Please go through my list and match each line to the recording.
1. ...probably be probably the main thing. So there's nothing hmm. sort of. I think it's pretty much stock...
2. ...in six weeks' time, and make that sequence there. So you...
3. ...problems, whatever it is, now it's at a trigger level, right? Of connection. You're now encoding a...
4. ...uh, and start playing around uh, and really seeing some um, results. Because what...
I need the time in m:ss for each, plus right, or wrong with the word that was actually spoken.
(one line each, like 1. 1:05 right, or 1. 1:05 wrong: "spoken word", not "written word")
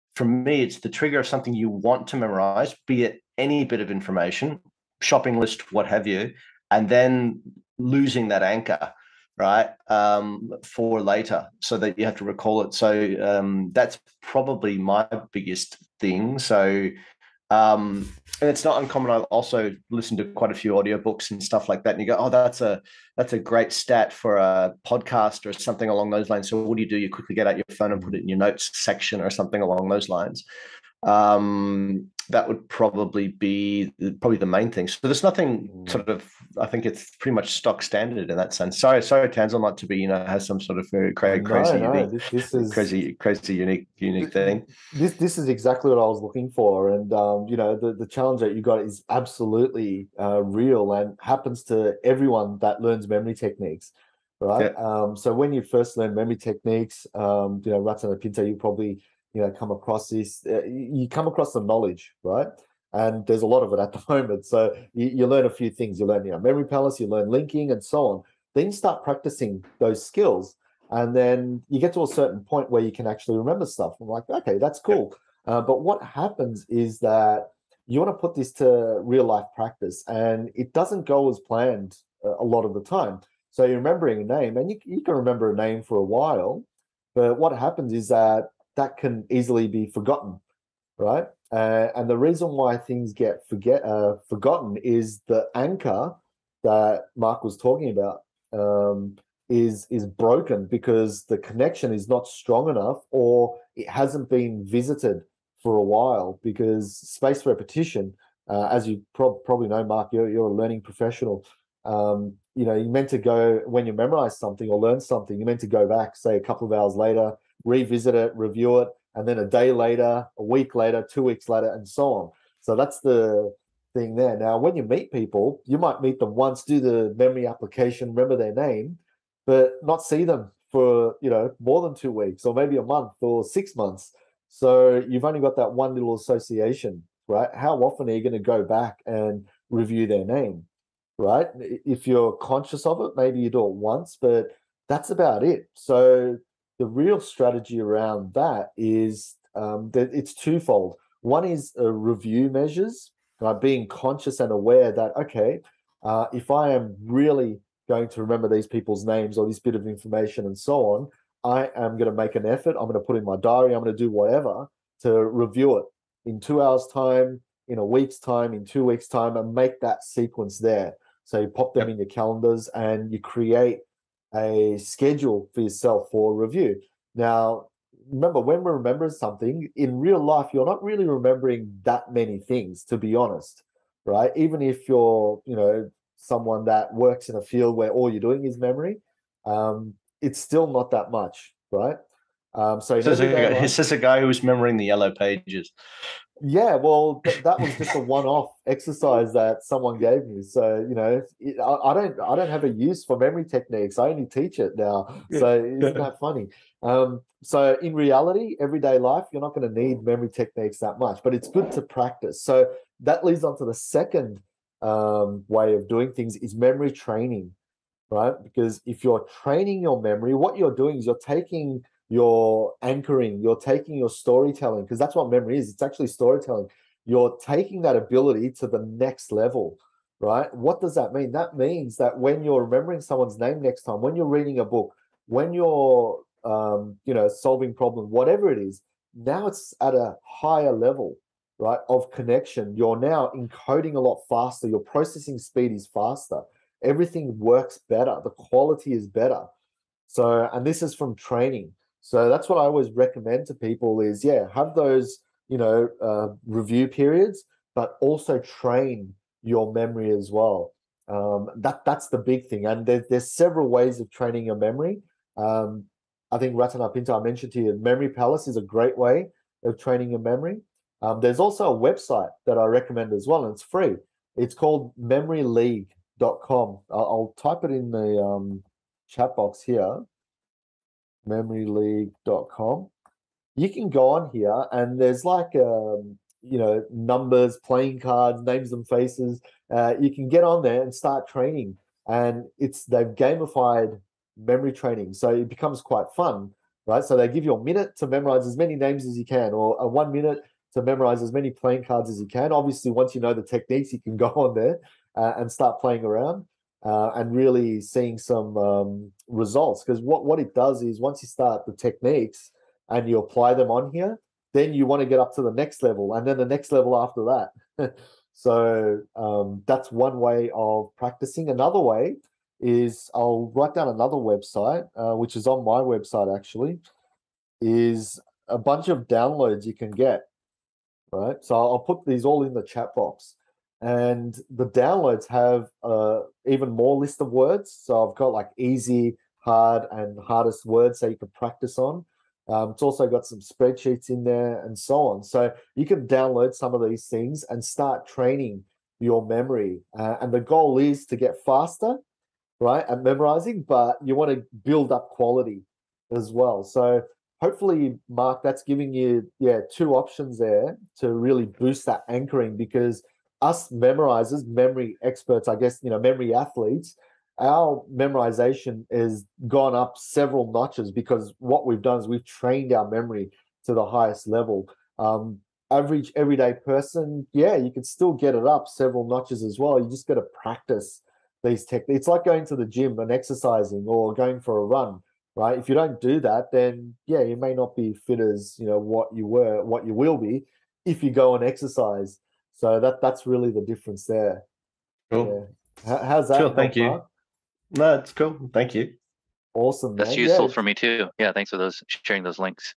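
1. 0:32 right
2. 2:48 wrong: "two", not "six"
3. 3:57 wrong: "higher", not "trigger"
4. 5:05 right.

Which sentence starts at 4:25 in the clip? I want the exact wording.
Um, I think Ratana Pinto, I mentioned to you, Memory Palace is a great way of training your memory.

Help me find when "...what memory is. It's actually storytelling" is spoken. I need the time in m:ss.
3:45.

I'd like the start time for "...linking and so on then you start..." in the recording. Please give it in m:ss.
1:07.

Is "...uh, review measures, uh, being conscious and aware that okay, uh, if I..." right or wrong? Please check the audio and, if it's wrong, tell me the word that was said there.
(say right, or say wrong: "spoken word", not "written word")
right.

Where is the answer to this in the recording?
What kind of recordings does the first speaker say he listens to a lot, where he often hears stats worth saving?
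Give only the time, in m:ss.
0:20.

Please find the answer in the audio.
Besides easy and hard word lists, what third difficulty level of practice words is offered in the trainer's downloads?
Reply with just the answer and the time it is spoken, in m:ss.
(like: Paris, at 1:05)
hardest, at 5:40.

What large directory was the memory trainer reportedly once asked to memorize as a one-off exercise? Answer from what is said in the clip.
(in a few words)
the yellow pages.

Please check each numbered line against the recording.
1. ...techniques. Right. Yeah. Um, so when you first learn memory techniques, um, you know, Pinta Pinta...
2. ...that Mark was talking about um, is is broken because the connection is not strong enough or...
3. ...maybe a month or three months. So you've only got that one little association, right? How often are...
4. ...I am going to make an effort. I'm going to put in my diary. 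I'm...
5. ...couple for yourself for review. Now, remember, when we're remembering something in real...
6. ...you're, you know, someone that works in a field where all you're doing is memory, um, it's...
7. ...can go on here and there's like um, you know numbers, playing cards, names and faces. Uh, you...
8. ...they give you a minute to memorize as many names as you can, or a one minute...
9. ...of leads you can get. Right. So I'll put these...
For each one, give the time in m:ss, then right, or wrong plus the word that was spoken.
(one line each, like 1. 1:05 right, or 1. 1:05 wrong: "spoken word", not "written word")
1. 0:53 wrong: "Ratana", not "Pinta"
2. 1:36 right
3. 2:12 wrong: "six", not "three"
4. 2:41 right
5. 2:54 wrong: "schedule", not "couple"
6. 3:04 right
7. 4:43 right
8. 4:57 right
9. 5:28 wrong: "downloads", not "leads".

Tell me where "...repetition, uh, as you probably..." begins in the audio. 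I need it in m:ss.
1:47.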